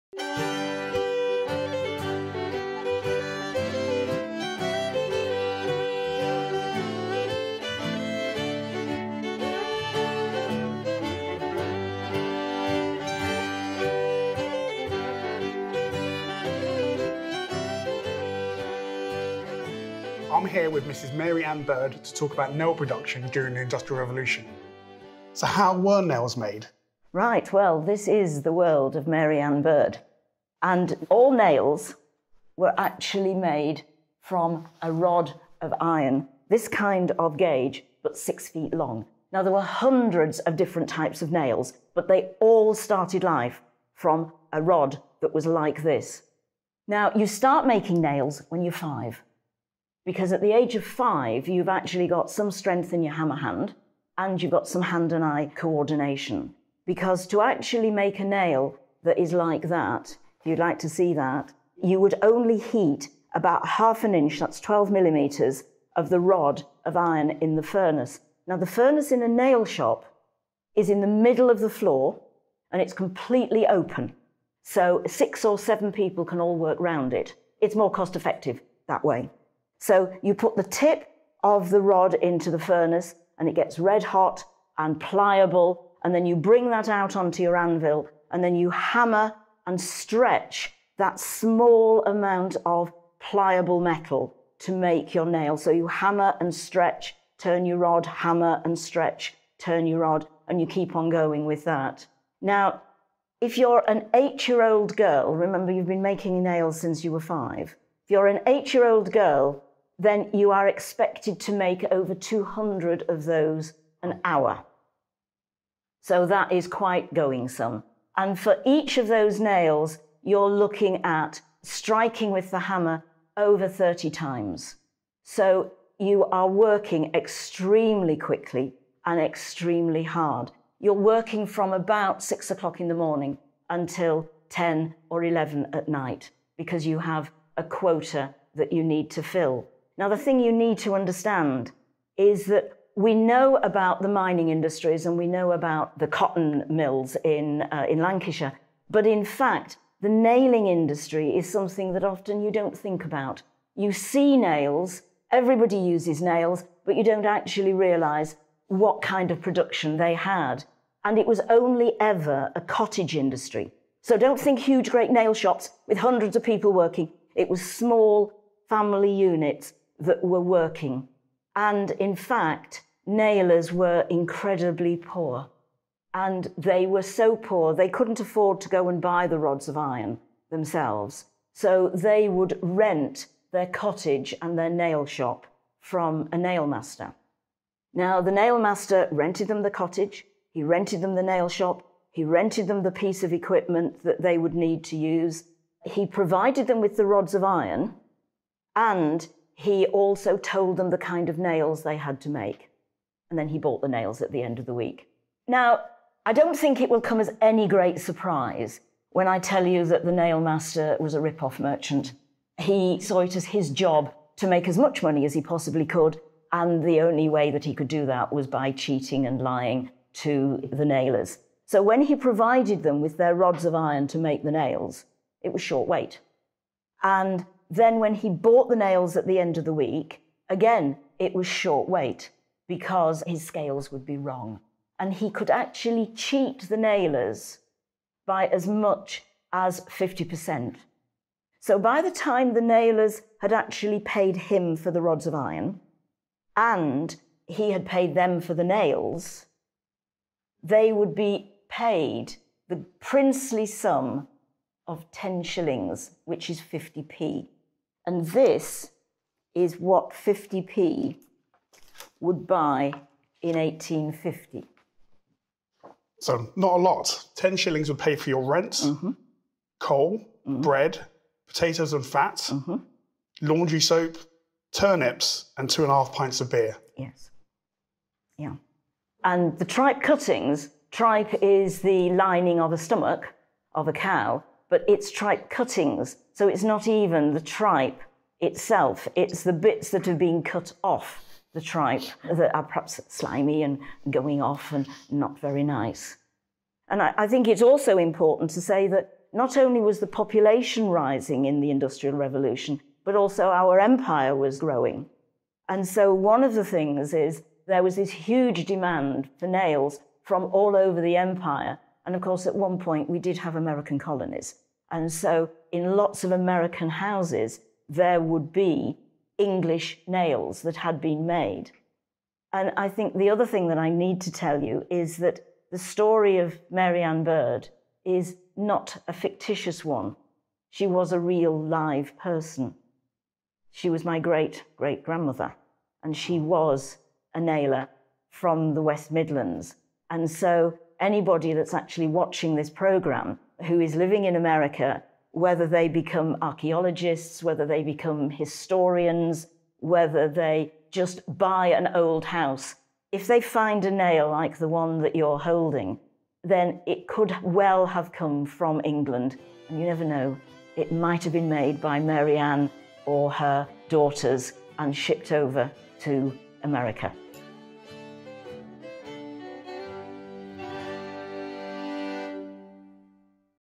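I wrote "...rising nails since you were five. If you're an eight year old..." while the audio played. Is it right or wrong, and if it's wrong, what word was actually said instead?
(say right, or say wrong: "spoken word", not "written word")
wrong: "making", not "rising".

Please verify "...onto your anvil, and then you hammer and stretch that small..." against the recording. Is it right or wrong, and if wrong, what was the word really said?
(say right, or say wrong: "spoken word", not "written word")
right.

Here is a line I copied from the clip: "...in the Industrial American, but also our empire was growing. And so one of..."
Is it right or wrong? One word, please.
wrong.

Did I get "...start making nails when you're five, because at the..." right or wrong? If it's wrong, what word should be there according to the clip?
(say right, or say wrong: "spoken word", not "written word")
right.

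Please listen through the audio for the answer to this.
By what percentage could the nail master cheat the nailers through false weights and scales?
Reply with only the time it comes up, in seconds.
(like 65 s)
239 s.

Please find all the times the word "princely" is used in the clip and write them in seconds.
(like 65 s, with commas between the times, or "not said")
252 s.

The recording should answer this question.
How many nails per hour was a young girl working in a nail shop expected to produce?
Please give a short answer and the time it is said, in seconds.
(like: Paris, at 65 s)
over 200, at 111 s.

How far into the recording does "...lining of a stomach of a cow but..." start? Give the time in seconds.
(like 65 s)
282 s.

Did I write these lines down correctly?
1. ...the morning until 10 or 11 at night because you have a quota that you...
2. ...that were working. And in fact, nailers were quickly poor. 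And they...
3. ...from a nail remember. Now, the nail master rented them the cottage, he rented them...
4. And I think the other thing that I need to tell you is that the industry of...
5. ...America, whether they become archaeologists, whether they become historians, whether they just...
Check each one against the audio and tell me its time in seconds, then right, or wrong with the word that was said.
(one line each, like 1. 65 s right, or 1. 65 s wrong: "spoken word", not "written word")
1. 132 s right
2. 169 s wrong: "incredibly", not "quickly"
3. 185 s wrong: "master", not "remember"
4. 322 s wrong: "story", not "industry"
5. 344 s right.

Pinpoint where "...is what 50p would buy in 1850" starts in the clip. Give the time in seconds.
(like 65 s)
259 s.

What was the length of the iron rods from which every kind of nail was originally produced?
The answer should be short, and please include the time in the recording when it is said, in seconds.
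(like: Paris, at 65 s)
6 feet, at 38 s.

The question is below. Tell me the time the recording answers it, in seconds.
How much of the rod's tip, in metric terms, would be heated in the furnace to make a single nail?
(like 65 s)
64 s.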